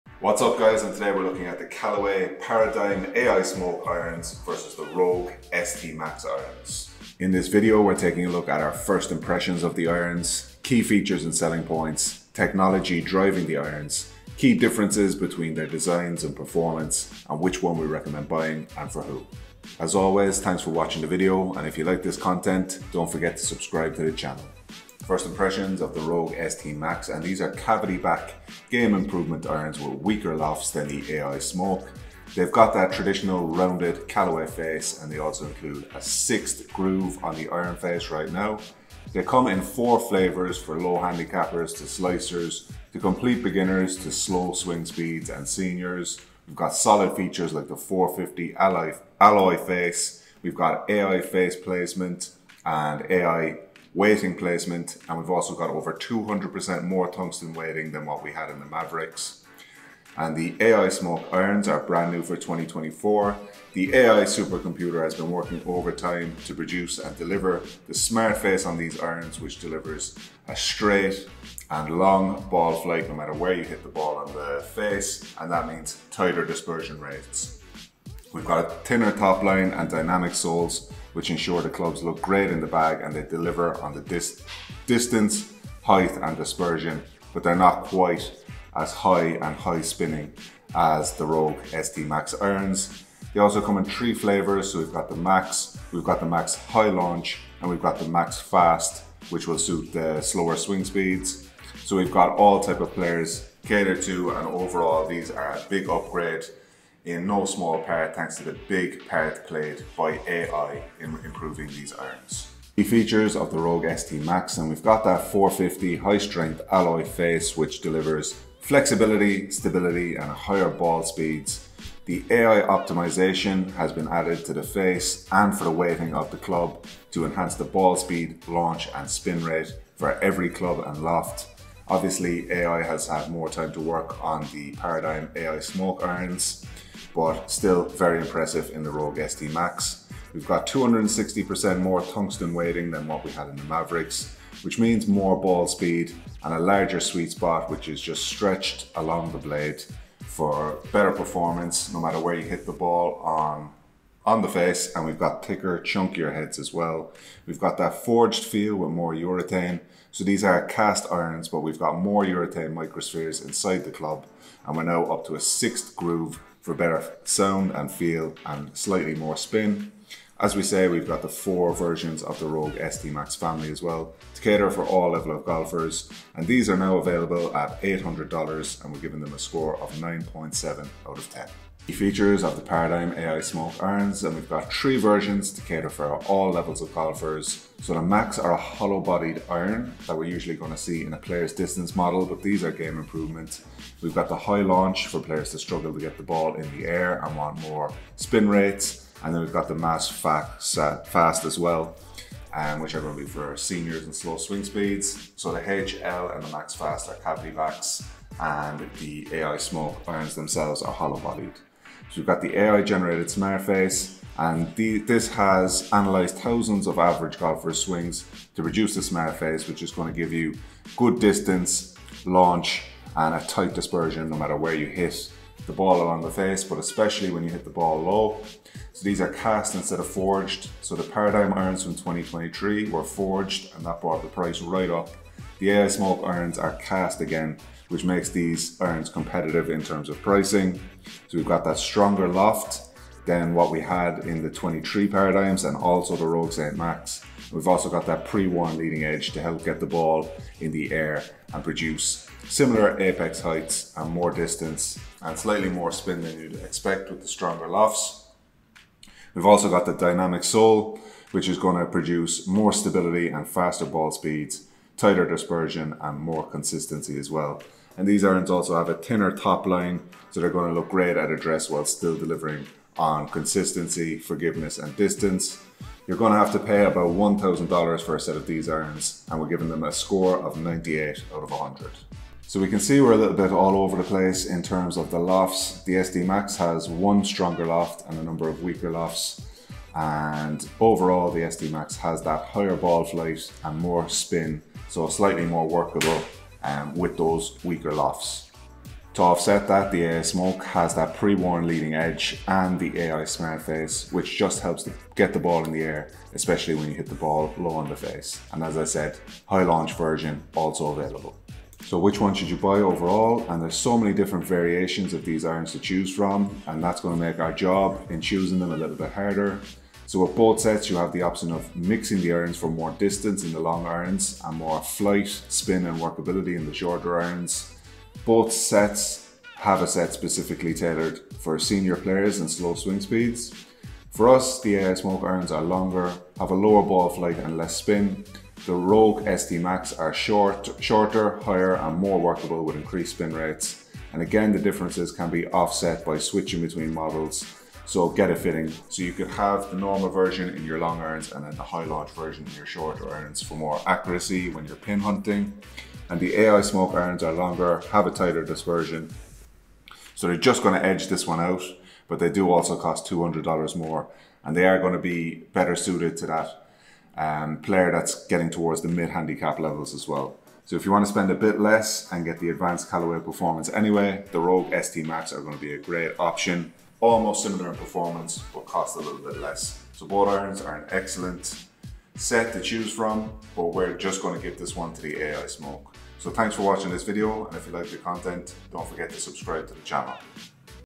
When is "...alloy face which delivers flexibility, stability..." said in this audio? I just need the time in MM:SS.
01:56.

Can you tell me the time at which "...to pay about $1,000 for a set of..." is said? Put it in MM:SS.
04:36.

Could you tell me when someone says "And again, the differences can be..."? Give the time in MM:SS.
05:44.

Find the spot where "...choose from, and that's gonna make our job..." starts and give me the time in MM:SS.
05:15.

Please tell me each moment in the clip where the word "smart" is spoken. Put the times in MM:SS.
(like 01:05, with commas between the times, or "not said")
01:07, 03:33, 03:39, 05:03.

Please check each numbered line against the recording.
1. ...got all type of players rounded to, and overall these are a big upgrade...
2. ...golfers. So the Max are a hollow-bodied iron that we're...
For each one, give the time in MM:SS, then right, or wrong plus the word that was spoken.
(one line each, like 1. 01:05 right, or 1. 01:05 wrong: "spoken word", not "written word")
1. 01:42 wrong: "catered", not "rounded"
2. 03:06 right.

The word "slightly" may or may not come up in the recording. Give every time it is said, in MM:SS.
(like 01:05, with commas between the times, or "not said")
02:48, 04:15, 04:55.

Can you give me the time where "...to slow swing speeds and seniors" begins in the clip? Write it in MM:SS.
00:44.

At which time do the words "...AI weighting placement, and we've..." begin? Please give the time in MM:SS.
00:53.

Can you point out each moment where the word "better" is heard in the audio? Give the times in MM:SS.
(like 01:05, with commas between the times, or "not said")
02:30, 02:46, 06:05.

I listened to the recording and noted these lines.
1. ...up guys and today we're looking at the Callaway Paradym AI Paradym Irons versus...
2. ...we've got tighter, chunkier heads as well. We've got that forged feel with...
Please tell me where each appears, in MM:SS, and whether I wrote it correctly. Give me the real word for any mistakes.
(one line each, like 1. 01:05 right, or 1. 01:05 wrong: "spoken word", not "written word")
1. 00:00 wrong: "Smoke", not "Paradym"
2. 02:35 wrong: "thicker", not "tighter".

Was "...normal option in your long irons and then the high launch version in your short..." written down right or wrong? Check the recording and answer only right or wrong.
wrong.